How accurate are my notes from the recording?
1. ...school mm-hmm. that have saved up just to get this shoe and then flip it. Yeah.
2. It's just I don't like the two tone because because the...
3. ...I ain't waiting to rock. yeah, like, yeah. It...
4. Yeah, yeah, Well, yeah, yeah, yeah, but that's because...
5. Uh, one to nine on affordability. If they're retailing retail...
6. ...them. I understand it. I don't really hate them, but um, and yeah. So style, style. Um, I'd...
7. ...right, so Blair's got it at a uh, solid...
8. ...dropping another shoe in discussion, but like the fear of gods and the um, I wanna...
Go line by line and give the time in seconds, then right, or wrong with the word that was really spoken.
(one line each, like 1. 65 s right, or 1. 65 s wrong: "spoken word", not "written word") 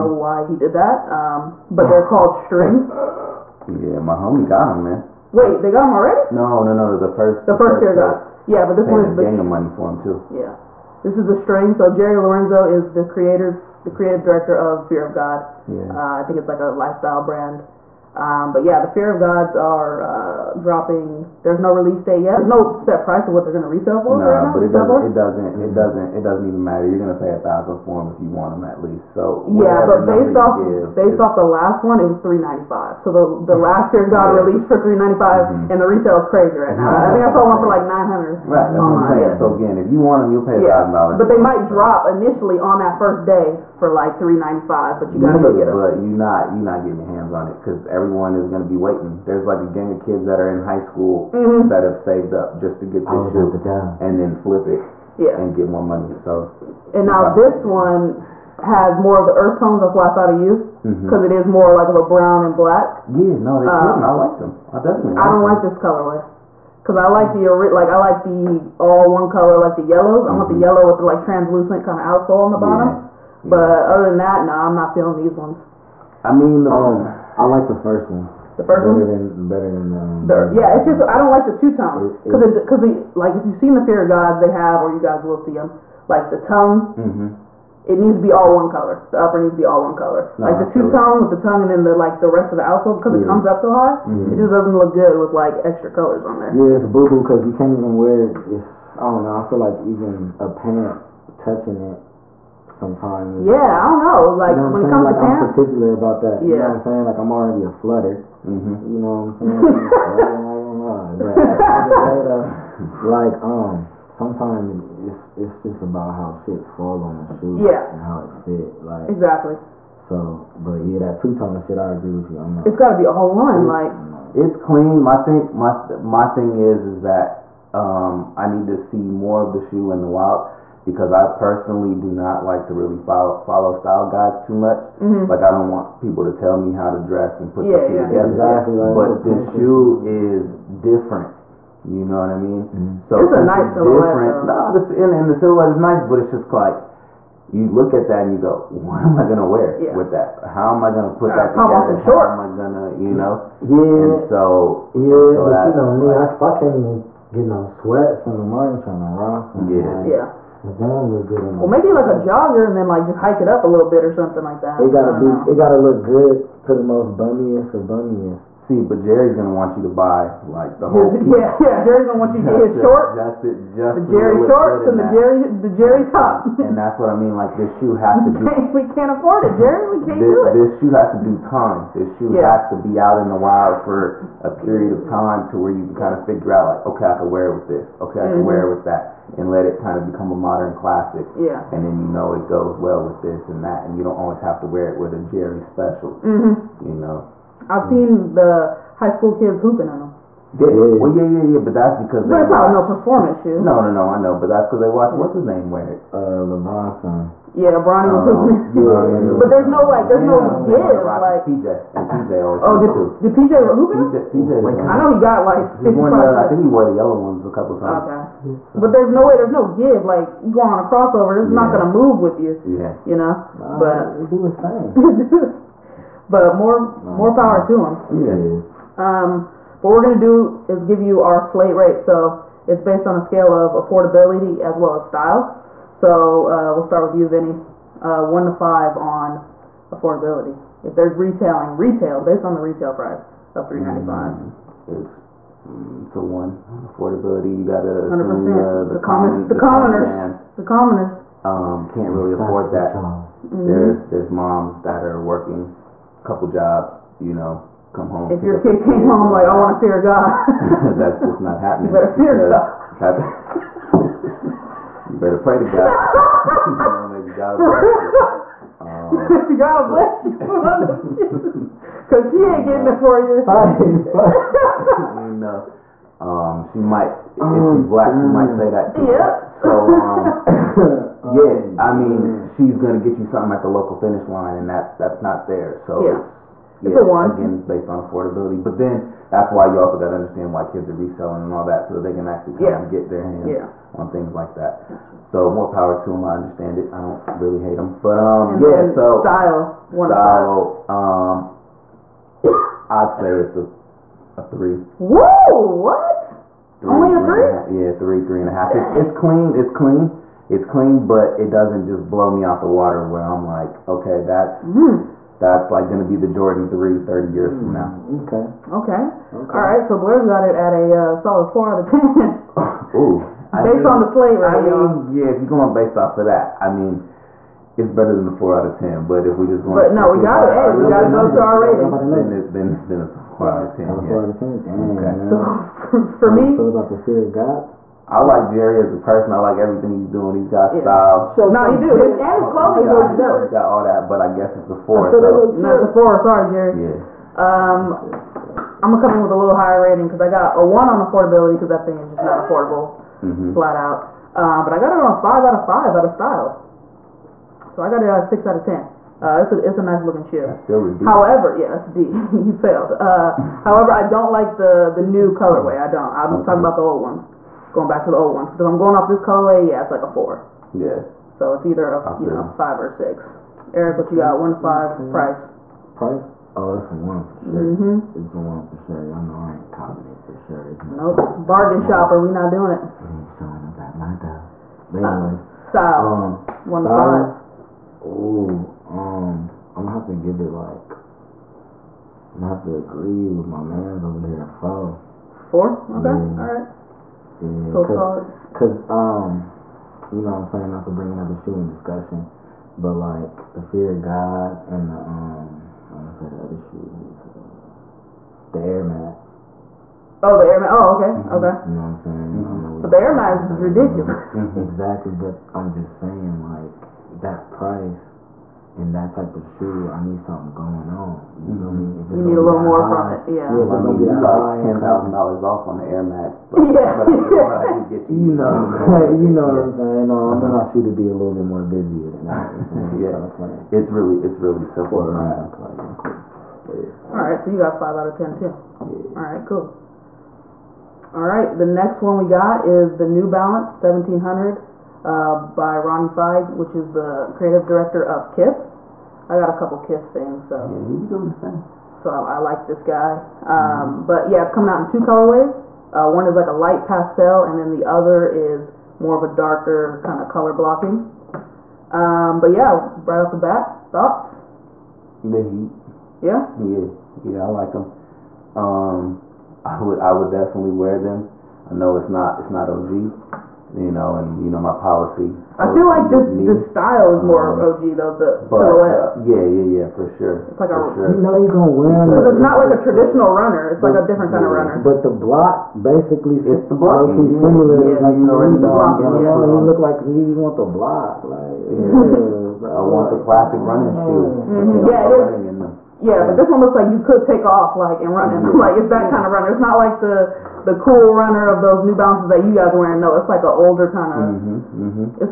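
1. 50 s right
2. 80 s right
3. 158 s wrong: "trying", not "waiting"
4. 200 s right
5. 237 s wrong: "five", not "nine"
6. 296 s right
7. 319 s right
8. 400 s wrong: "bring", not "dropping".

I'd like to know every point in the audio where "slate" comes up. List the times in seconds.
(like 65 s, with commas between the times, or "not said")
231 s, 324 s.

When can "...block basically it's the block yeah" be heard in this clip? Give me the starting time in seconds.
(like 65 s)
485 s.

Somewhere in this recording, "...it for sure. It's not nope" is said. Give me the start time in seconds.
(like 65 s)
380 s.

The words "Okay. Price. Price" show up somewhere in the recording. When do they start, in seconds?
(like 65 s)
374 s.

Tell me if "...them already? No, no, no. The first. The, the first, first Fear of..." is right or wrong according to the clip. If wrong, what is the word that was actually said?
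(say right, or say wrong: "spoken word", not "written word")
right.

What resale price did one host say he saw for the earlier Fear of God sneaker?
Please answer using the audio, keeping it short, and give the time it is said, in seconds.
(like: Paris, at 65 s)
900, at 37 s.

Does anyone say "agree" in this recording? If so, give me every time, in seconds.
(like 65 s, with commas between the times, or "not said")
121 s, 392 s.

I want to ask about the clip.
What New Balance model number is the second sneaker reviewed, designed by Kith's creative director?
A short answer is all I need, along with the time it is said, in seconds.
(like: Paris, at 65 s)
1700, at 443 s.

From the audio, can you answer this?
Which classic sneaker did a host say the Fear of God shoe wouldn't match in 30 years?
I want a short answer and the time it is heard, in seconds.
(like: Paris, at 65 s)
Jordan 3, at 316 s.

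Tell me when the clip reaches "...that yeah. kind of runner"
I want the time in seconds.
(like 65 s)
498 s.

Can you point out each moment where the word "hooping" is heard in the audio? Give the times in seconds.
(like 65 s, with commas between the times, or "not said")
199 s, 208 s, 213 s.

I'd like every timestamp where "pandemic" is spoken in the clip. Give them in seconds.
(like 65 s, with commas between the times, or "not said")
not said.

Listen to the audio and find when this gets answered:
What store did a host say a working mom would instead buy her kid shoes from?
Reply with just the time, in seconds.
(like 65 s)
283 s.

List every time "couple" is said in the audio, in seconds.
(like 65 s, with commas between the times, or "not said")
217 s, 256 s, 449 s.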